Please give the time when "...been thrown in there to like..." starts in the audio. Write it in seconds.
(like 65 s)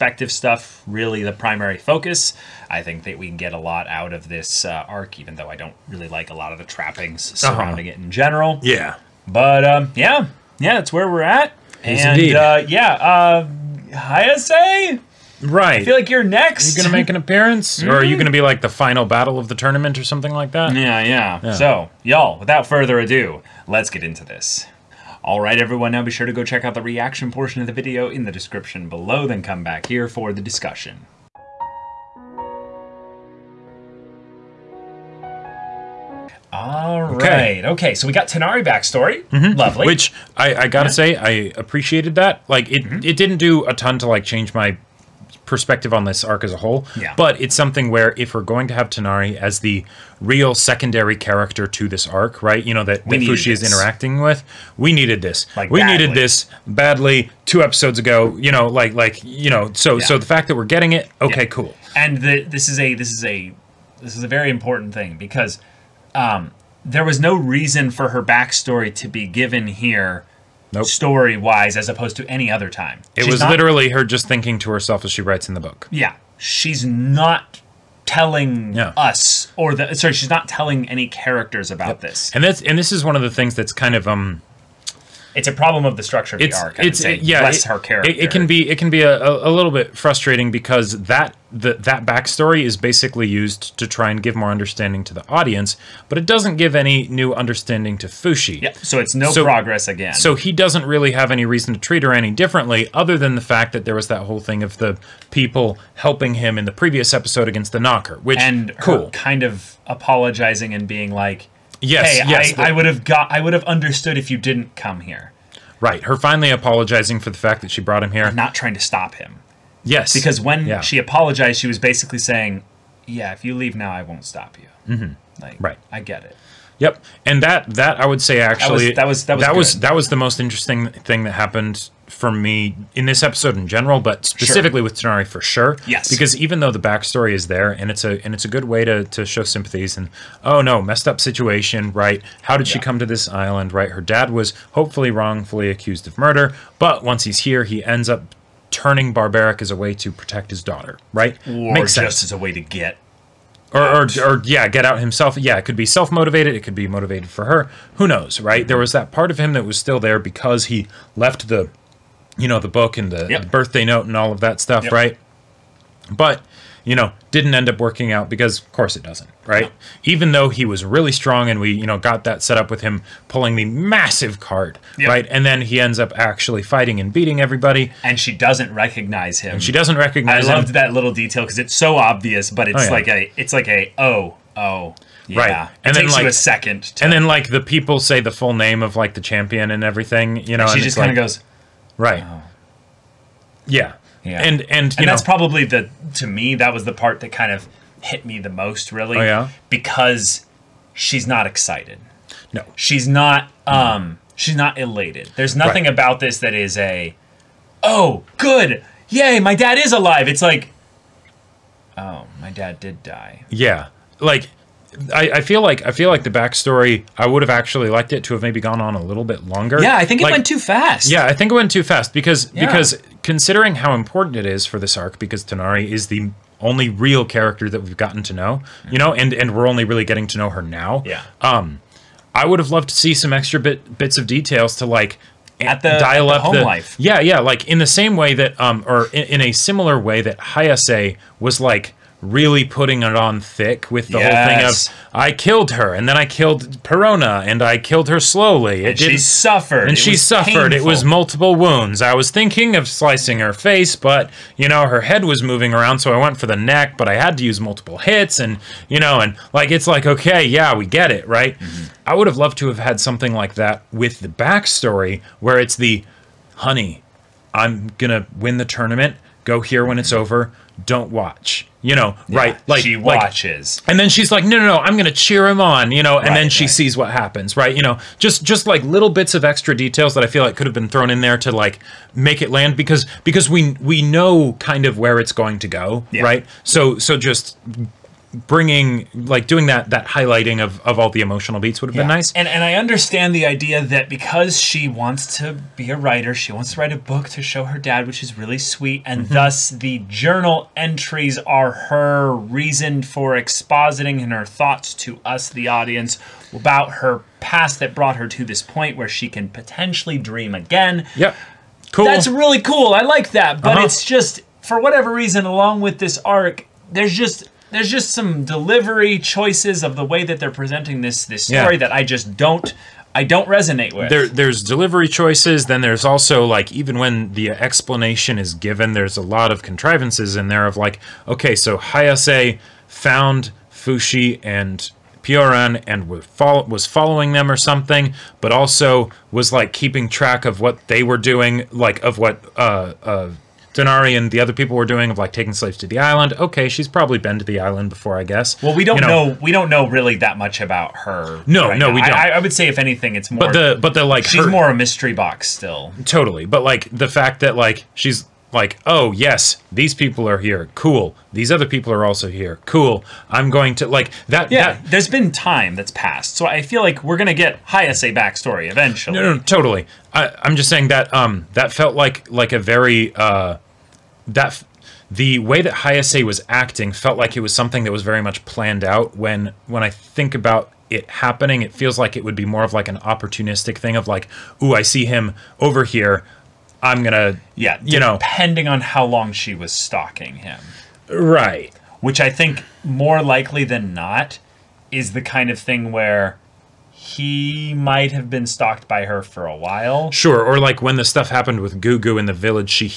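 280 s.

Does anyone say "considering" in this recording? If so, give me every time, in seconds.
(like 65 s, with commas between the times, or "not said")
223 s.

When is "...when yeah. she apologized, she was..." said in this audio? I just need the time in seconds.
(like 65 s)
120 s.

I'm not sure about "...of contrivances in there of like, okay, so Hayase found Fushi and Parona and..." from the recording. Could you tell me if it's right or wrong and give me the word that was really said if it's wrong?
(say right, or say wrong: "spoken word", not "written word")
wrong: "Pioran", not "Parona".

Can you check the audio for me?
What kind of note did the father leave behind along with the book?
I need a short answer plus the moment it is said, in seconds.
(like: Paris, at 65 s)
Birthday note, at 163 s.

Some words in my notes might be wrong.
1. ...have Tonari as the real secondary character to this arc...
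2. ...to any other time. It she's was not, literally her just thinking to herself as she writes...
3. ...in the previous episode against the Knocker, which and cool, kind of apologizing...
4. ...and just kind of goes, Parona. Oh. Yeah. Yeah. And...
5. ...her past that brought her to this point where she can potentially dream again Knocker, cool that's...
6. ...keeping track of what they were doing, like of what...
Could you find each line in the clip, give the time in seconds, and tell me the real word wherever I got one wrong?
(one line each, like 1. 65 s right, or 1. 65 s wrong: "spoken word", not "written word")
1. 48 s right
2. 72 s right
3. 106 s right
4. 190 s wrong: "Right", not "Parona"
5. 306 s wrong: "Yeah", not "Knocker"
6. 339 s right.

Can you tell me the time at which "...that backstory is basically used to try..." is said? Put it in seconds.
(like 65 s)
91 s.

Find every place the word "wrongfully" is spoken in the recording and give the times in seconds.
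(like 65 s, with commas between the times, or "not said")
145 s.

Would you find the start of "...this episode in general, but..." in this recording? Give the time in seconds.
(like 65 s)
133 s.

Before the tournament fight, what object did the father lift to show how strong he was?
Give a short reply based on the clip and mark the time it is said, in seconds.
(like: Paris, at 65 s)
The massive card, at 173 s.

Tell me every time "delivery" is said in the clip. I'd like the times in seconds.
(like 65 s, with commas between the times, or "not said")
318 s, 324 s.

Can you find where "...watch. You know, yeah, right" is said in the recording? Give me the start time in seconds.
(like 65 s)
271 s.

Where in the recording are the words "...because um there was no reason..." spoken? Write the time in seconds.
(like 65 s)
65 s.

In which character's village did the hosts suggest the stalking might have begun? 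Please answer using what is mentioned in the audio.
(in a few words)
Gugu.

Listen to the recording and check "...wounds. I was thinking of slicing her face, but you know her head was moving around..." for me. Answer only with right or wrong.
right.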